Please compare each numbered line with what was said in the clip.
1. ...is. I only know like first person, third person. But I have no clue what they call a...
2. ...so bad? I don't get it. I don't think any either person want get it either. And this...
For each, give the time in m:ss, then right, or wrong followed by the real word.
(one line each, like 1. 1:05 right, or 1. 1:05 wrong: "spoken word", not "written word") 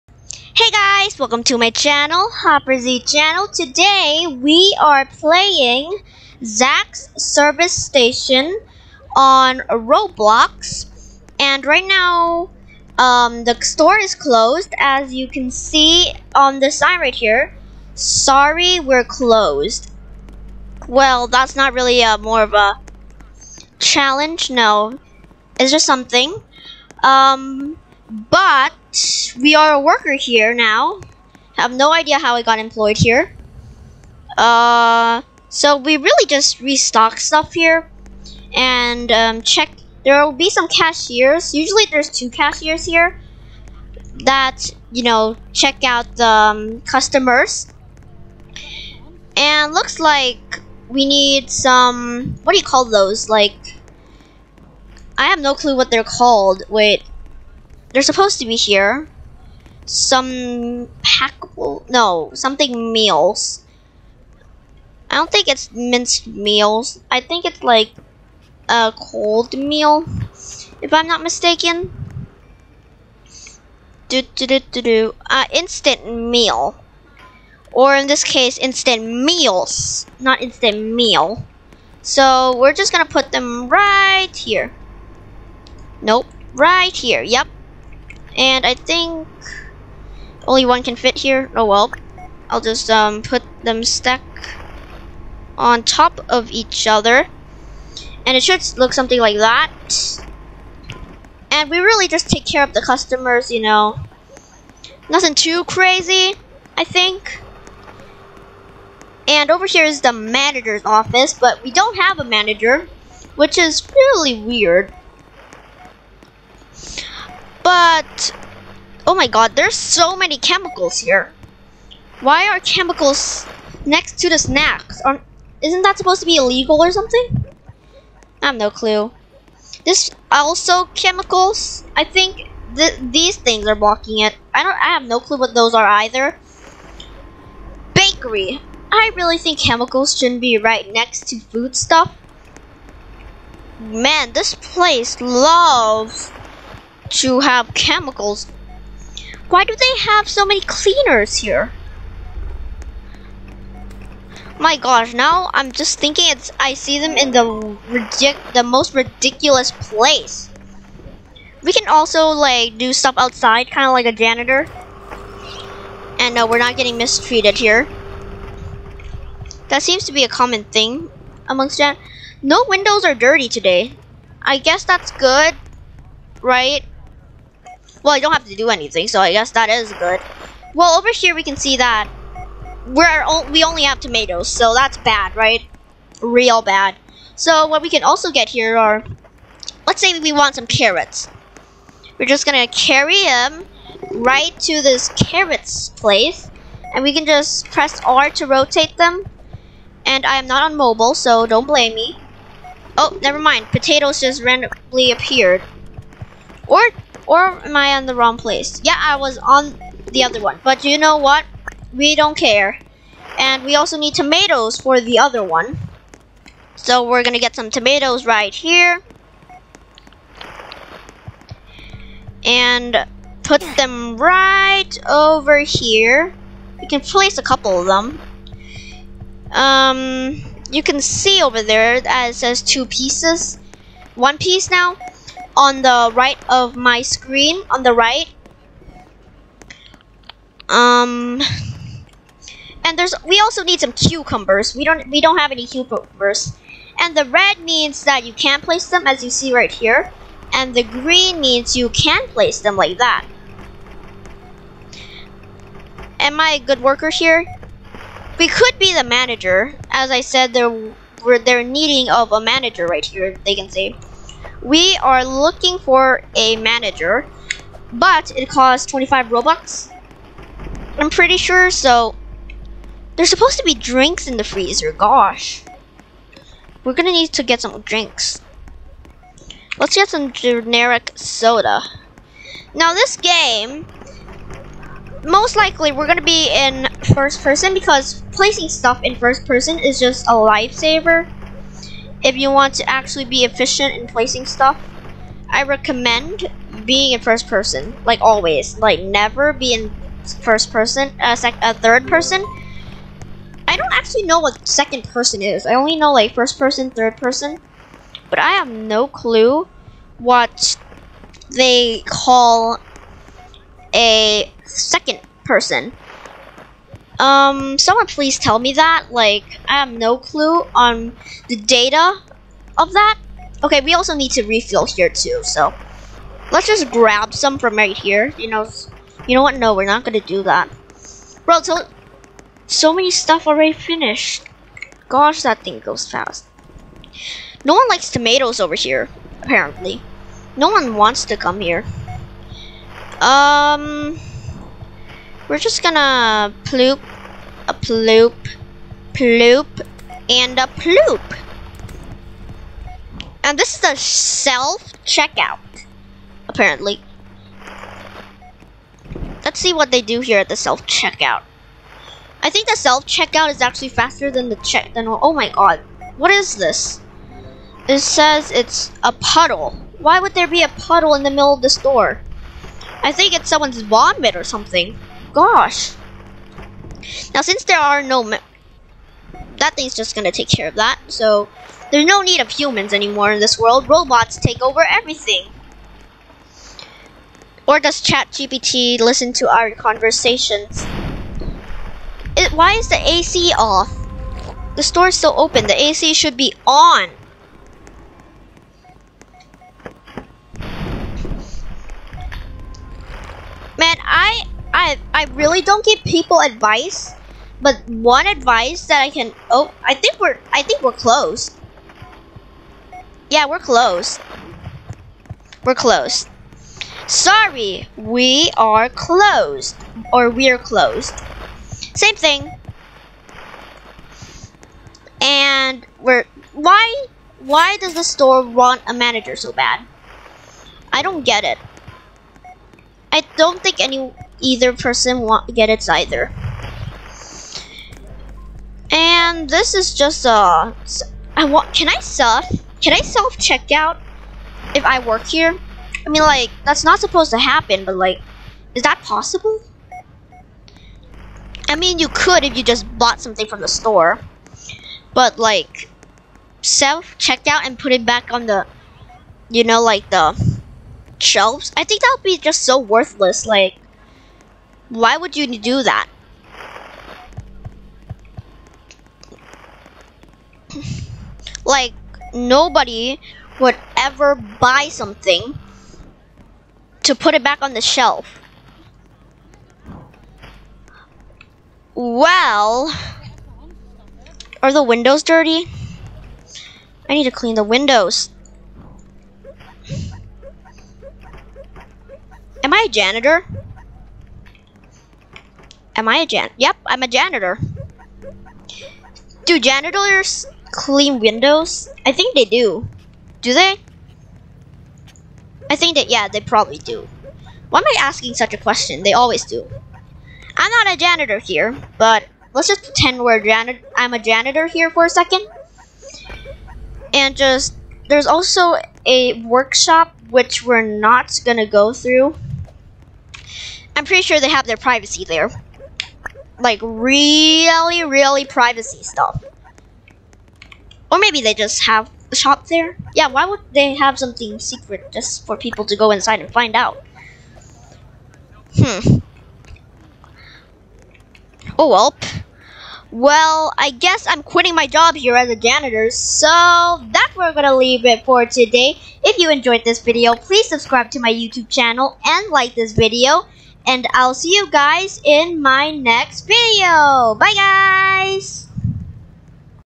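1. 5:05 right
2. 7:09 right.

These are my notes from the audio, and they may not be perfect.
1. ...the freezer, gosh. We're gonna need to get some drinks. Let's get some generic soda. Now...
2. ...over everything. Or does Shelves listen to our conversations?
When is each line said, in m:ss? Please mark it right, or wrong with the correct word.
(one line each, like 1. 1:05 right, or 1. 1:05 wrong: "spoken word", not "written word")
1. 4:34 right
2. 6:24 wrong: "ChatGPT", not "Shelves".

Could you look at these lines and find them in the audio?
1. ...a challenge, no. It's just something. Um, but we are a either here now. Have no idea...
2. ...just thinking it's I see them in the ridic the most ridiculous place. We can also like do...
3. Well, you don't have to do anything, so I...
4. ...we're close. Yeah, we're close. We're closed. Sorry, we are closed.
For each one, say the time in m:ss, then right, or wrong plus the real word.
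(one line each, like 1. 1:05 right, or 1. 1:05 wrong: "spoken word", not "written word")
1. 0:22 wrong: "worker", not "either"
2. 2:35 right
3. 2:58 right
4. 6:50 right.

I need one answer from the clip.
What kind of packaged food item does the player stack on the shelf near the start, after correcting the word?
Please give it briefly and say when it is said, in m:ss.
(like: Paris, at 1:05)
Instant meals, at 1:18.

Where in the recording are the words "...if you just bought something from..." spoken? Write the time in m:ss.
7:32.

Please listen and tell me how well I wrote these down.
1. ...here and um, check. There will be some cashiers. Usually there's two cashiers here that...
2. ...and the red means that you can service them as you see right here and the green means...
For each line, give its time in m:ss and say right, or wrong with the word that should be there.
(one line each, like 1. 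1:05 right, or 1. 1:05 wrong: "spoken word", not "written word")
1. 0:37 right
2. 4:06 wrong: "place", not "service".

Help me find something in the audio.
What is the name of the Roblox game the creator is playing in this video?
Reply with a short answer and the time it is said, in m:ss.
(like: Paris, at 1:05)
Zach's service station, at 0:06.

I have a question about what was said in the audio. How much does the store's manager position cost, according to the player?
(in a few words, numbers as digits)
25 Robux.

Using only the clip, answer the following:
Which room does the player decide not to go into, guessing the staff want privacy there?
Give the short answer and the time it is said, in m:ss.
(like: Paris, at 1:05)
Workshop, at 8:39.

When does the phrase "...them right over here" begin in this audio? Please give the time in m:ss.
3:43.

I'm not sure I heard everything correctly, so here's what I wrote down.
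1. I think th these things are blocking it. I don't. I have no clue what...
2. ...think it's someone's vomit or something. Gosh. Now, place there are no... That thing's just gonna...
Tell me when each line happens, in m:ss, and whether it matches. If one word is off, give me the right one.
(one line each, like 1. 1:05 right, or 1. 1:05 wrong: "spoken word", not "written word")
1. 2:11 right
2. 6:13 wrong: "since", not "place".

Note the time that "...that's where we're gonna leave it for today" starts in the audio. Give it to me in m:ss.
9:07.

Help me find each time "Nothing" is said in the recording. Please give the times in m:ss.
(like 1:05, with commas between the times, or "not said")
1:45.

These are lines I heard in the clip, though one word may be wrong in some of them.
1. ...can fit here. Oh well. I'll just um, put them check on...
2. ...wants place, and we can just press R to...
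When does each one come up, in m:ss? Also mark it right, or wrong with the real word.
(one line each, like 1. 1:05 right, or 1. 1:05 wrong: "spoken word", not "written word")
1. 1:30 wrong: "stack", not "check"
2. 3:15 wrong: "carrots", not "wants".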